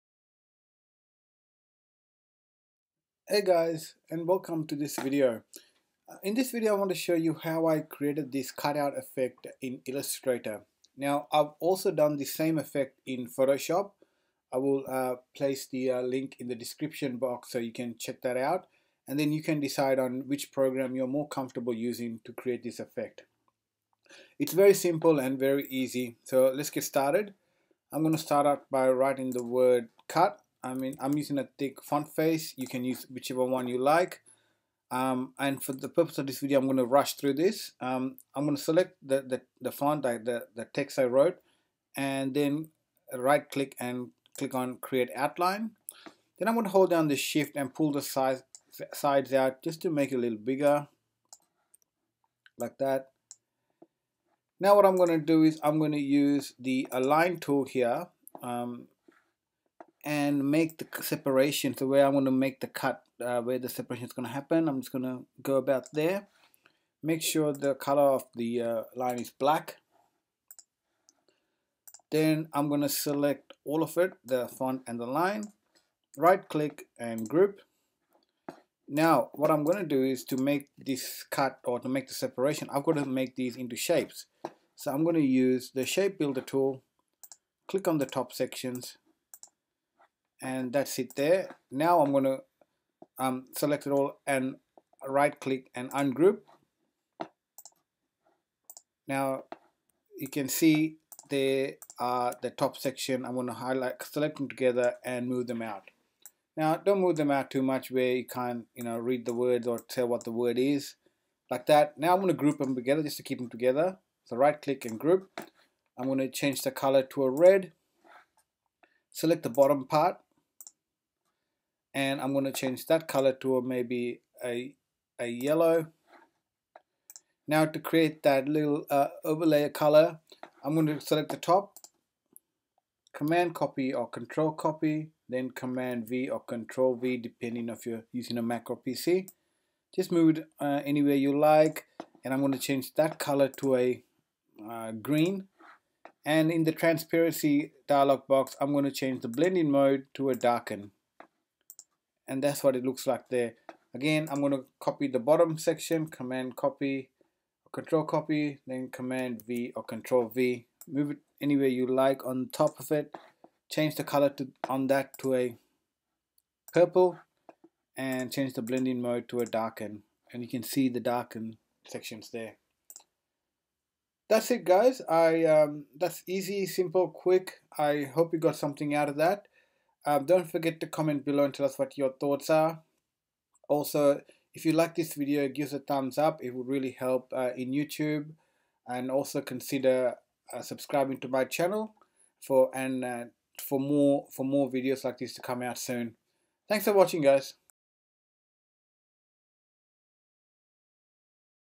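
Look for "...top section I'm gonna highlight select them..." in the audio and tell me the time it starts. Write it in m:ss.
1:42.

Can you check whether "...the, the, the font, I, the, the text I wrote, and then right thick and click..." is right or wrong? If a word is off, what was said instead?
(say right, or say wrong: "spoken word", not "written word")
wrong: "click", not "thick".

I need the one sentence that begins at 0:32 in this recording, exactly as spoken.
You can use whichever one you like.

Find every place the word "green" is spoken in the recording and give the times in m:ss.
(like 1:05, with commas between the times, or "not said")
2:24.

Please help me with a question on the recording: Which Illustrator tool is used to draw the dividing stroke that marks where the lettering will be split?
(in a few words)
line tool.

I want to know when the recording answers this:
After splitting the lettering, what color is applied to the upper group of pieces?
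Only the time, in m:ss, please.
1:57.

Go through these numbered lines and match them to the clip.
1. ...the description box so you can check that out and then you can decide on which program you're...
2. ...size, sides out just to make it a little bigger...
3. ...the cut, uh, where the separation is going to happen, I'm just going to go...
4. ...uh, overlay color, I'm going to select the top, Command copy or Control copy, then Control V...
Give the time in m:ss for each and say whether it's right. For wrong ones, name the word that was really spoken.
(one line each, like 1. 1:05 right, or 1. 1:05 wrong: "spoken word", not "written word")
1. 0:16 right
2. 0:48 right
3. 1:02 right
4. 2:08 wrong: "Command", not "Control".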